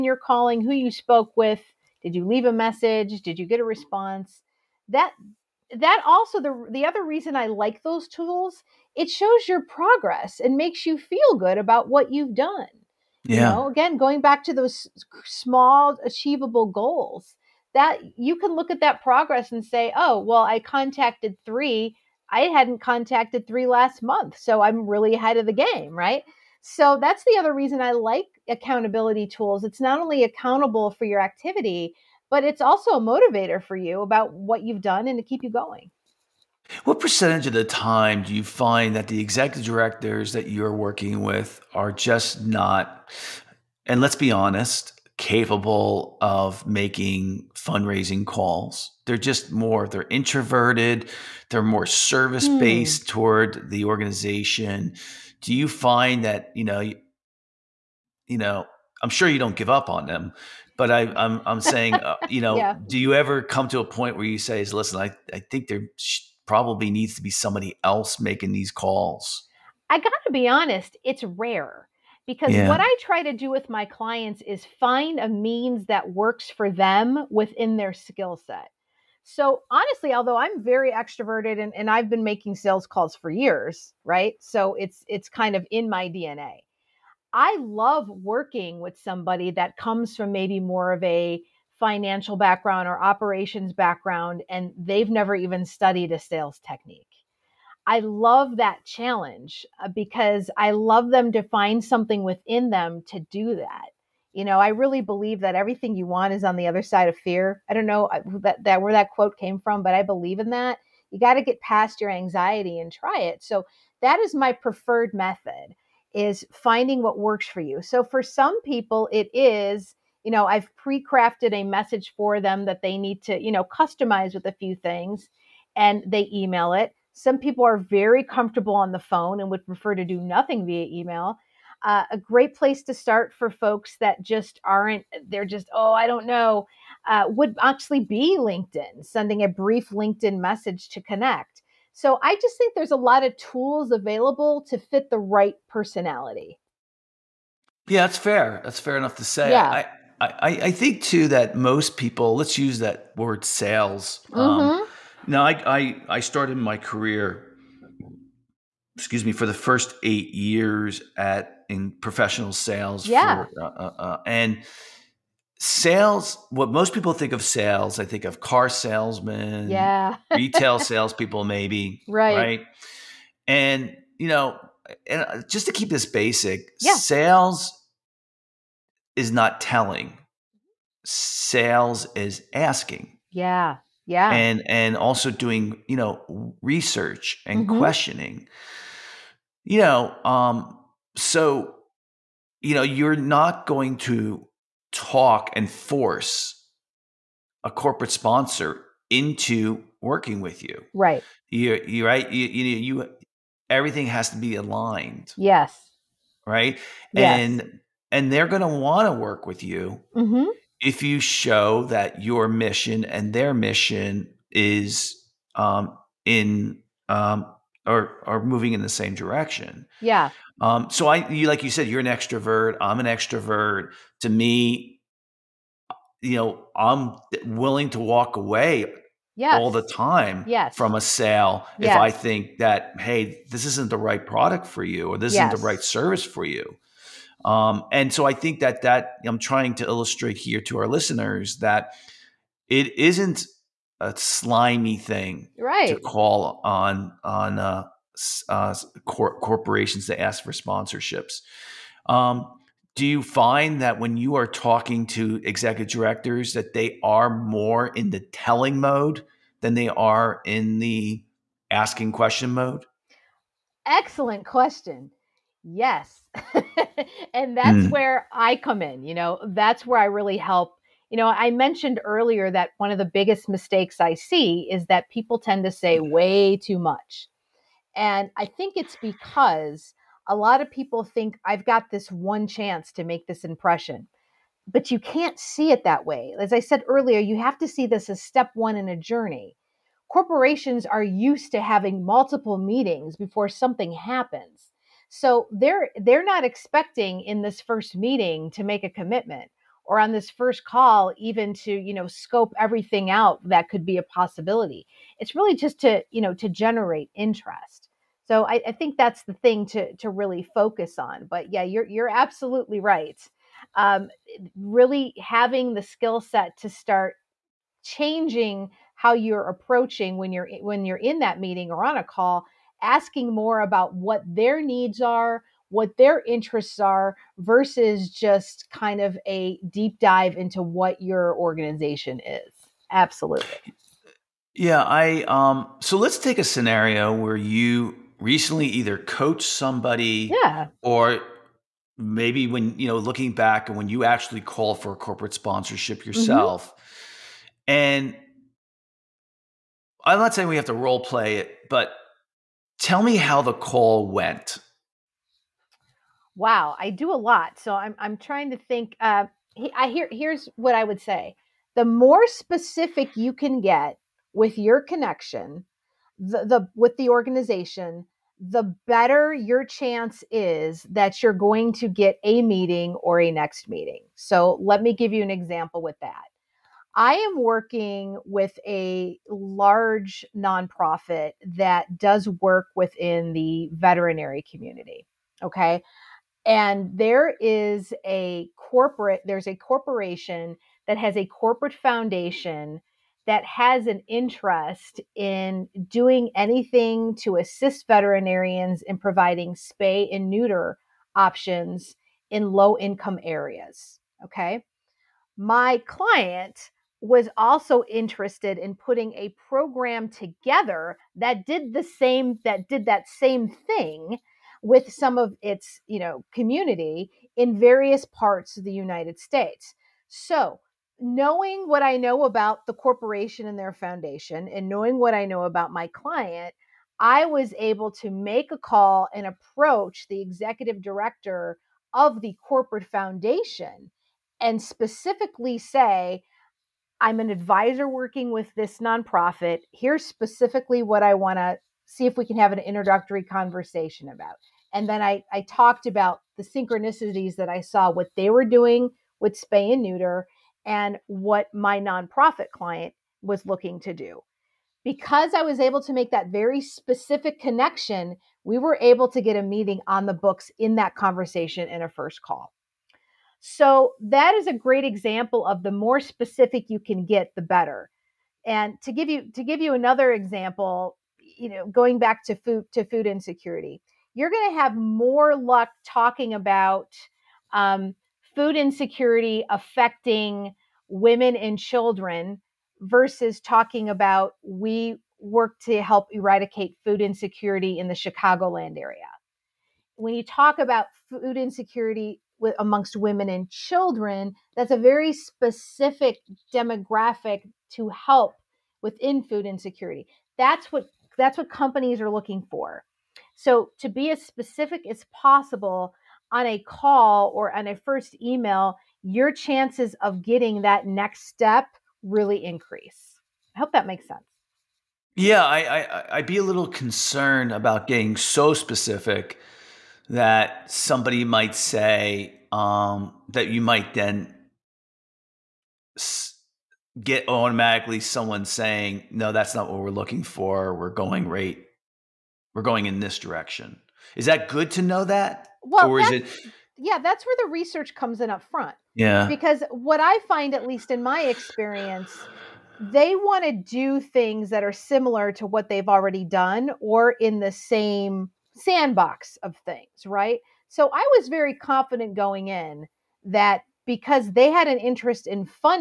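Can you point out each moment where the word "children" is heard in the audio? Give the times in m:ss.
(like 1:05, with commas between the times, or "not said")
8:01, 8:13.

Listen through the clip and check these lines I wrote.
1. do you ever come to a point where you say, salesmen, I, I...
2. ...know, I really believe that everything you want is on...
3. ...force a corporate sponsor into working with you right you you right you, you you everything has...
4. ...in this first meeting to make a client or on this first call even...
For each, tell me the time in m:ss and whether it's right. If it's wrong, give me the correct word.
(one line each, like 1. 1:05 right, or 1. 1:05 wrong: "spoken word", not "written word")
1. 1:02 wrong: "listen", not "salesmen"
2. 1:44 right
3. 3:15 right
4. 4:57 wrong: "commitment", not "client".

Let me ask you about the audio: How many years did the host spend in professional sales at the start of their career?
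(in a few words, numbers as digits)
8.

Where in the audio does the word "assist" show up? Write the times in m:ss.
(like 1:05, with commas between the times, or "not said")
6:37.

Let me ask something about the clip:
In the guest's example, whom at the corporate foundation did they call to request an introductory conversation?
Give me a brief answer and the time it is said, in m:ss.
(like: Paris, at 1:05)
The executive director, at 7:10.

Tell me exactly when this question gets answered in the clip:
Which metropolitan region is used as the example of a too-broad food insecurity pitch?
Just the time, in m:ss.
8:07.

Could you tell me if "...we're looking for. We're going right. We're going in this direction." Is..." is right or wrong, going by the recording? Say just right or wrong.
right.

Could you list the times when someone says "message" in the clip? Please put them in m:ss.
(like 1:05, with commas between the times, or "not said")
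0:02, 2:01, 2:20.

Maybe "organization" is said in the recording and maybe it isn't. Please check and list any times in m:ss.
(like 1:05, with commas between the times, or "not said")
0:53, 5:31, 6:07.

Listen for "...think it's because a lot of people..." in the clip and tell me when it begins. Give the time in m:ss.
4:38.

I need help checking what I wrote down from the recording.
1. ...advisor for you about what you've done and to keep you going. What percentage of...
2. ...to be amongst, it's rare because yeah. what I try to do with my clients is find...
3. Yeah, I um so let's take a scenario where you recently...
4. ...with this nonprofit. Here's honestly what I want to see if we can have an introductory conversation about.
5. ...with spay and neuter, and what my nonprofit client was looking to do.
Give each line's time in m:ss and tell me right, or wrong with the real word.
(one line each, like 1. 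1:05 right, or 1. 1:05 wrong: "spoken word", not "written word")
1. 0:32 wrong: "motivator", not "advisor"
2. 1:10 wrong: "honest", not "amongst"
3. 5:34 right
4. 7:18 wrong: "specifically", not "honestly"
5. 7:29 right.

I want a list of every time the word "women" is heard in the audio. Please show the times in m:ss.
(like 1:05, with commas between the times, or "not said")
8:00, 8:12.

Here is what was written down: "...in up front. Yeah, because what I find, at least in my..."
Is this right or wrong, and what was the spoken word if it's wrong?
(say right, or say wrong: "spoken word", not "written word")
right.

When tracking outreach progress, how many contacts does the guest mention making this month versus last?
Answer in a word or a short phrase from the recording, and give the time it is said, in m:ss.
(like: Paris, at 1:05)
3, at 0:20.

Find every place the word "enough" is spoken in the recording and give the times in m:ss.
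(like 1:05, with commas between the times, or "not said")
2:28.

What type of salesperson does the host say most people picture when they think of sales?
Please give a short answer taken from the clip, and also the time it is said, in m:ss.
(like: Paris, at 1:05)
Car salesmen, at 2:48.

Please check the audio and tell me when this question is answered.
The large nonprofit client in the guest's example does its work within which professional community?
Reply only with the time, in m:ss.
6:23.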